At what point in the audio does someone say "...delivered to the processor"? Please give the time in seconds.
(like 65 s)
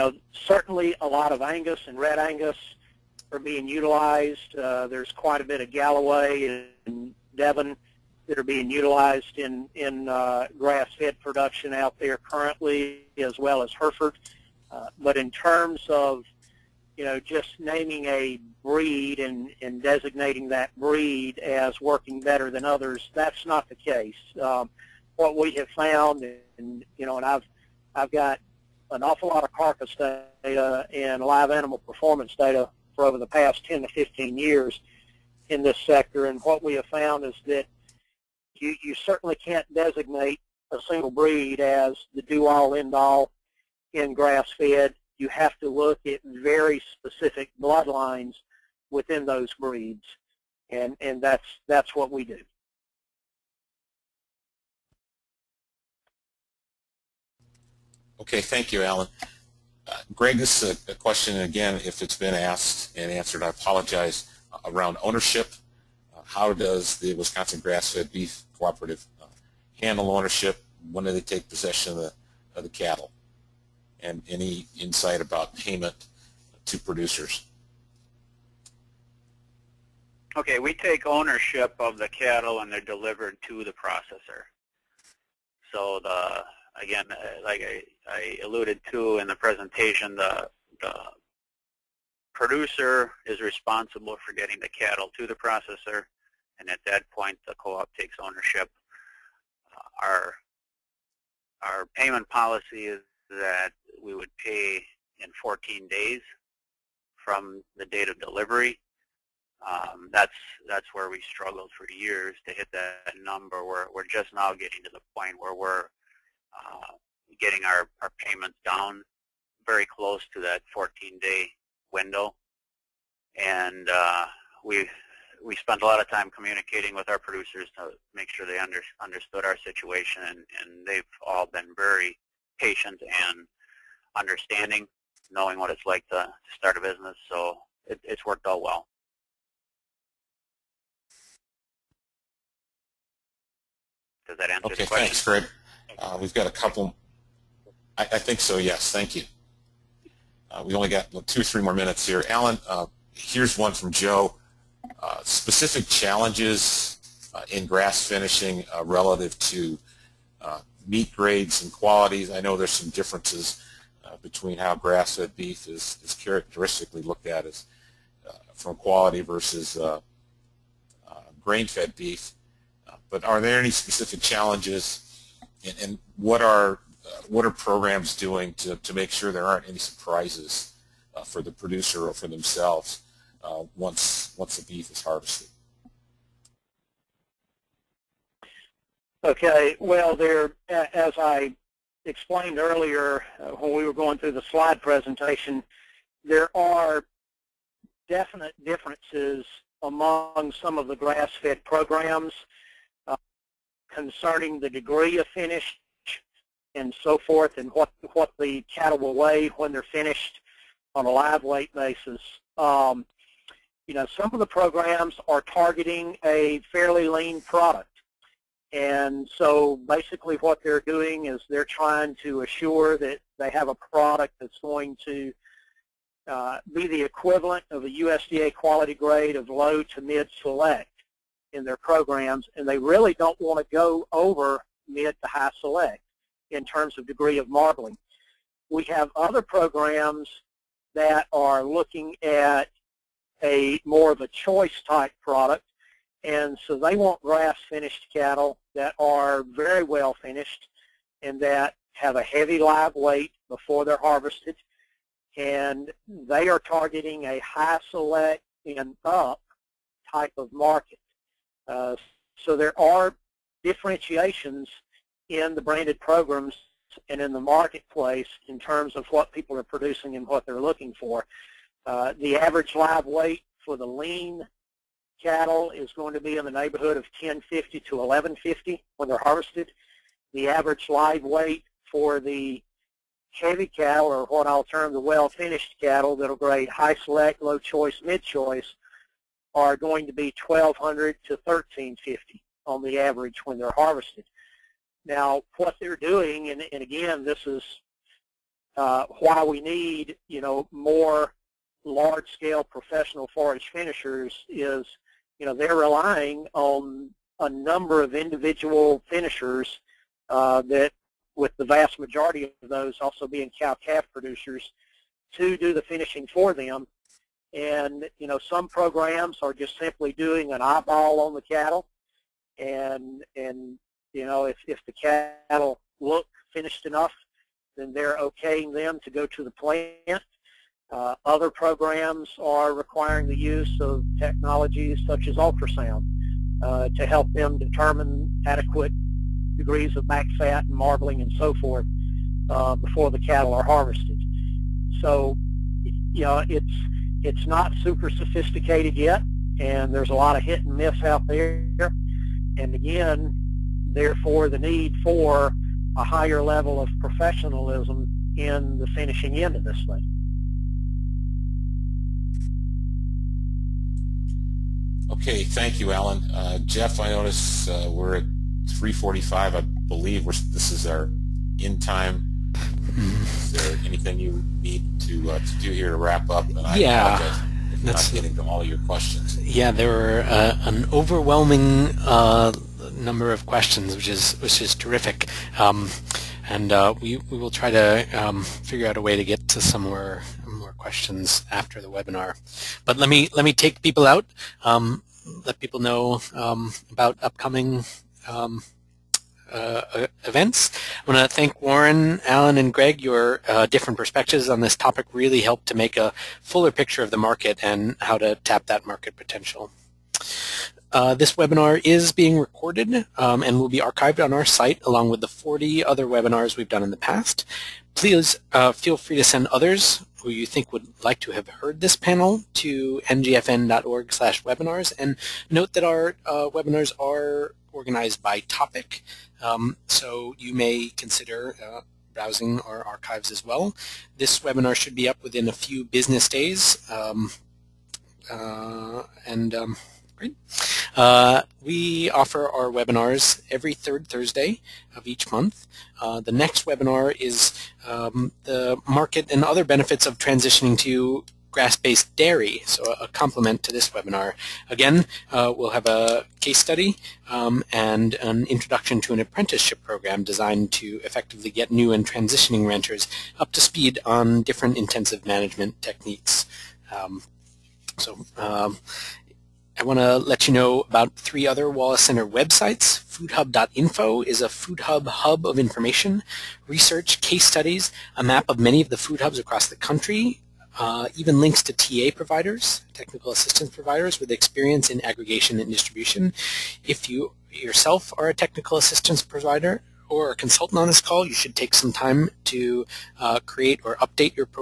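82 s.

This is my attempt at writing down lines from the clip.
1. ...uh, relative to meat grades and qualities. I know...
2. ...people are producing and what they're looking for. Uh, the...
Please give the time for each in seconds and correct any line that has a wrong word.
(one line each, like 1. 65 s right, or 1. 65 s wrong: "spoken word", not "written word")
1. 158 s right
2. 269 s right.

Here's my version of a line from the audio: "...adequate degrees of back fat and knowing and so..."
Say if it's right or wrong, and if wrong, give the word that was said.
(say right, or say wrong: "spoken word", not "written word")
wrong: "marbling", not "knowing".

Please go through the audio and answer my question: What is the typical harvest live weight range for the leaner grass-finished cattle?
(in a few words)
1050 to 1150.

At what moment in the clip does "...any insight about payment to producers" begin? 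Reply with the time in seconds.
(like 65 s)
74 s.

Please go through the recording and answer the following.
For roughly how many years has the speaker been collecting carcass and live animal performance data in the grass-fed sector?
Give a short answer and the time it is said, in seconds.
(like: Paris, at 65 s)
10 to 15 years, at 33 s.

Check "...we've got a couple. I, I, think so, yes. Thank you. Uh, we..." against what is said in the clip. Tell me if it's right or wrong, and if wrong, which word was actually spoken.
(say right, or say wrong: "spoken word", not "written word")
right.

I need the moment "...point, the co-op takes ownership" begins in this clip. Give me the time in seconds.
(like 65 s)
97 s.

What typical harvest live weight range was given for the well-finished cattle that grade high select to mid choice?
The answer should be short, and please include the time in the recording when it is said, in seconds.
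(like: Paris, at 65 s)
1200 to 1350, at 290 s.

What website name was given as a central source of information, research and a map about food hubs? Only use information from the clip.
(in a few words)
Foodhub.info.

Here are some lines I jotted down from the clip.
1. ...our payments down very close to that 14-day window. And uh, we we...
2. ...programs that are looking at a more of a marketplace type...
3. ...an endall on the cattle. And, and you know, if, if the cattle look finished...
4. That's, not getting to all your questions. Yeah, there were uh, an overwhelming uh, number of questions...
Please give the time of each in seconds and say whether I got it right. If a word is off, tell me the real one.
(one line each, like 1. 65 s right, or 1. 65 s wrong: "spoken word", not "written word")
1. 118 s right
2. 239 s wrong: "choice", not "marketplace"
3. 320 s wrong: "eyeball", not "endall"
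4. 377 s right.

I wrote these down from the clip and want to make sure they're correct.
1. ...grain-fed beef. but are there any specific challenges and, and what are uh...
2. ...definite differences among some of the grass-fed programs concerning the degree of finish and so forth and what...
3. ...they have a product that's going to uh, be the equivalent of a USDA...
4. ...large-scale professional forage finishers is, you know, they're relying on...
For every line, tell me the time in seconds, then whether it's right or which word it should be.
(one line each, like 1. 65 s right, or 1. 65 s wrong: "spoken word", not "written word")
1. 171 s right
2. 198 s right
3. 223 s right
4. 301 s right.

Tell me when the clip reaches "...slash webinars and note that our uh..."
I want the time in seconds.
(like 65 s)
424 s.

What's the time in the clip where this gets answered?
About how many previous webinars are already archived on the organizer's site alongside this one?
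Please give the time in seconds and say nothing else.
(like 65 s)
415 s.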